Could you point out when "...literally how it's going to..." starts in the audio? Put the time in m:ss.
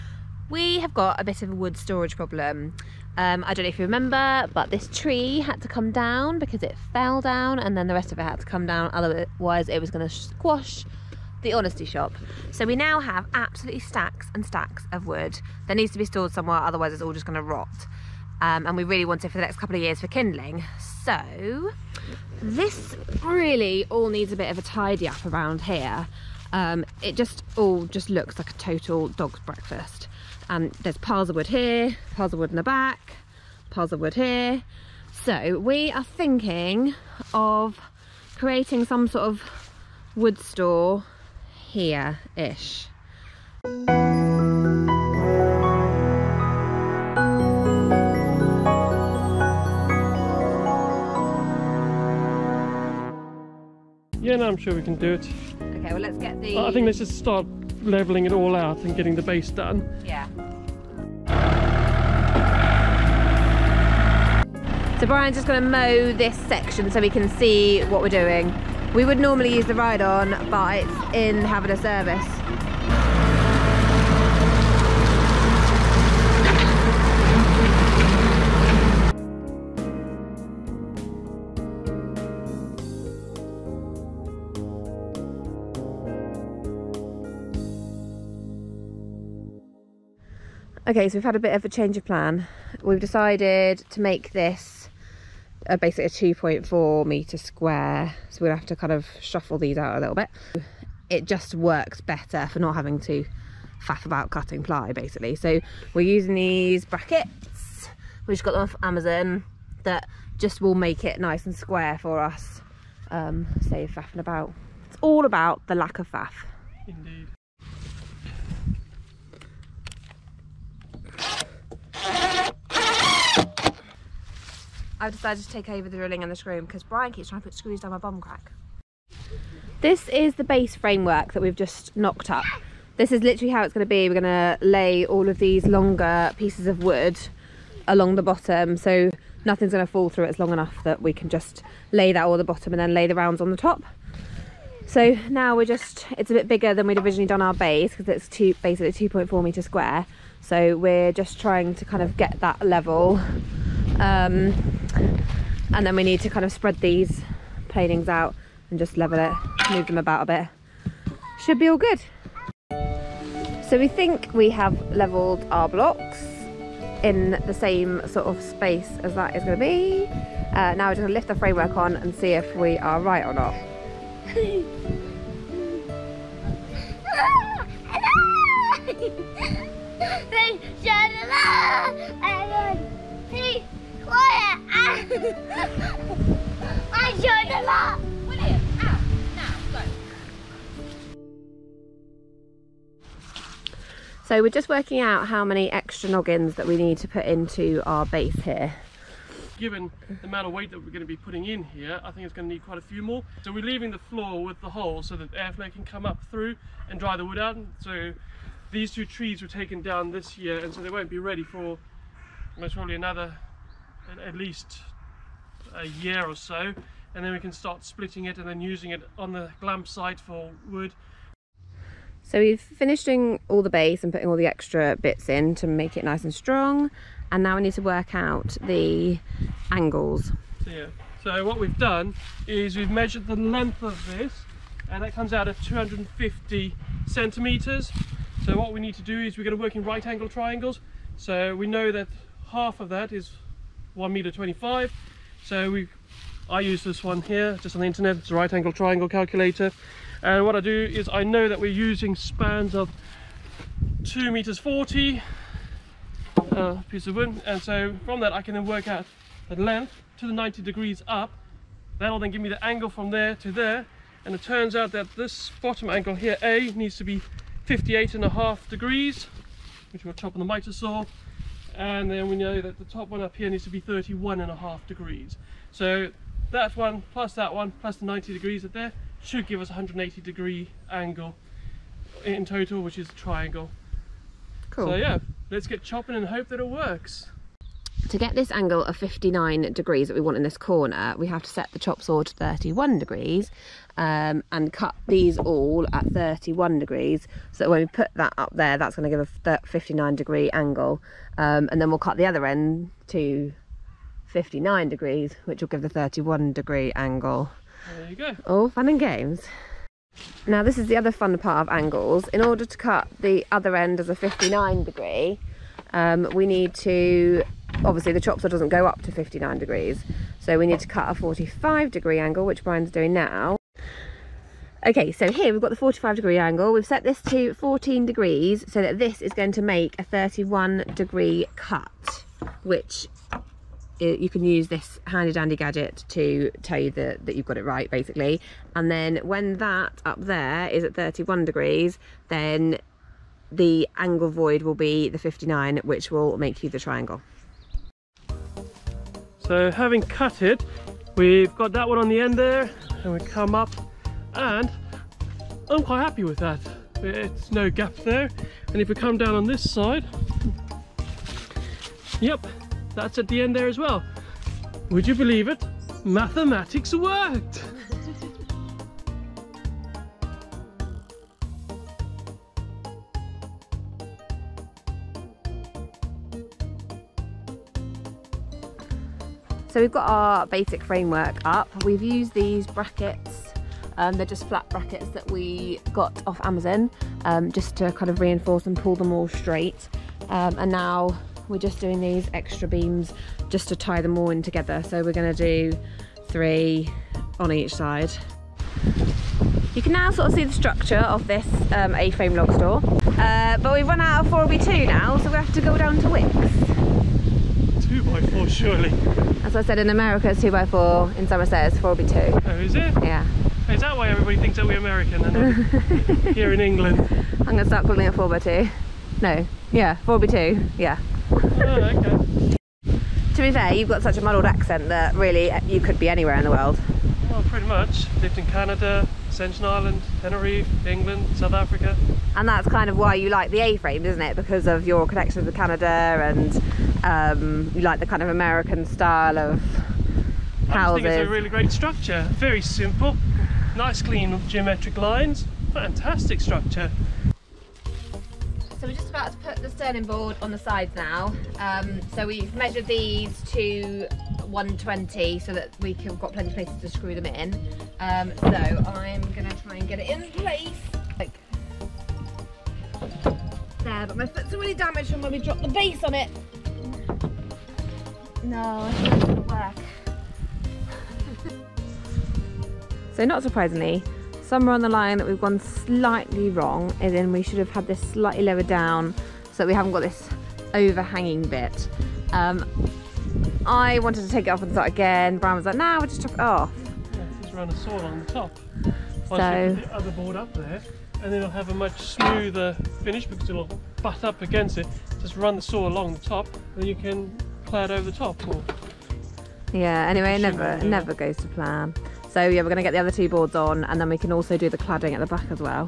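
2:13.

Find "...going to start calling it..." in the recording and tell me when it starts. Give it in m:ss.
6:57.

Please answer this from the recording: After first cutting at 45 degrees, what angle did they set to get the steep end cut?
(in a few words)
14 degrees.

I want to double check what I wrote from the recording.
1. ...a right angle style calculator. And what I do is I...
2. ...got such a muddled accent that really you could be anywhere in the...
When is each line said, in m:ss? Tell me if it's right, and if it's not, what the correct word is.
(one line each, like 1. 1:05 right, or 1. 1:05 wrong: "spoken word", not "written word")
1. 4:08 wrong: "triangle", not "style"
2. 7:03 right.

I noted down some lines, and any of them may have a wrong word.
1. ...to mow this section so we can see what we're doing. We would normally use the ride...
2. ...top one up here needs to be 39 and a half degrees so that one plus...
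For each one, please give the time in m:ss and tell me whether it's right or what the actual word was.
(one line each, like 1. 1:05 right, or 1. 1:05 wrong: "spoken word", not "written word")
1. 1:05 right
2. 4:32 wrong: "31", not "39".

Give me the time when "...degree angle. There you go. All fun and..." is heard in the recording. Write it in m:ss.
5:06.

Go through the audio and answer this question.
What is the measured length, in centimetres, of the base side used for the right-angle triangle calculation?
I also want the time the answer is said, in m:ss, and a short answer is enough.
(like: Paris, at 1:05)
250, at 3:55.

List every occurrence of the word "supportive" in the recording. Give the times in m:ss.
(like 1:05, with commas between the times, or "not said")
not said.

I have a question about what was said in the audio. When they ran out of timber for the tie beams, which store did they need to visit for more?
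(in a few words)
Wickes.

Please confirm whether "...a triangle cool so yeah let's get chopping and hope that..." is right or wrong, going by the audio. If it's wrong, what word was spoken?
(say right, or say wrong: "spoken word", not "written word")
right.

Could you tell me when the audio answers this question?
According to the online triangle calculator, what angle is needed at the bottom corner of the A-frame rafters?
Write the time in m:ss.
4:27.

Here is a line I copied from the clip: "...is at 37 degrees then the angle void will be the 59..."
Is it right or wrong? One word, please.
wrong.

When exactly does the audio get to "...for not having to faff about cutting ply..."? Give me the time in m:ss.
1:42.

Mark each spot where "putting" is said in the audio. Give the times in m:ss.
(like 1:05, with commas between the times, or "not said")
3:21, 3:44.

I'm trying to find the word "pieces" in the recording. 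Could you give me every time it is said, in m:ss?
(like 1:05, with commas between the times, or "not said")
2:16, 4:16.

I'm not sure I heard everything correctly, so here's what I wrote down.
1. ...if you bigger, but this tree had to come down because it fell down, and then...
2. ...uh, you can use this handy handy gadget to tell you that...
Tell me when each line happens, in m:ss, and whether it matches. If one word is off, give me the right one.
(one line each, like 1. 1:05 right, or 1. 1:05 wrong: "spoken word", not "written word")
1. 0:03 wrong: "remember", not "bigger"
2. 5:33 wrong: "dandy", not "handy".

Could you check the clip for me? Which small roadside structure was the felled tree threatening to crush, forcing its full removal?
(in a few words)
the honesty shop.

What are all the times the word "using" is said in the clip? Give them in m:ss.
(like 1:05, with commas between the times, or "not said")
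1:46, 3:38, 4:11.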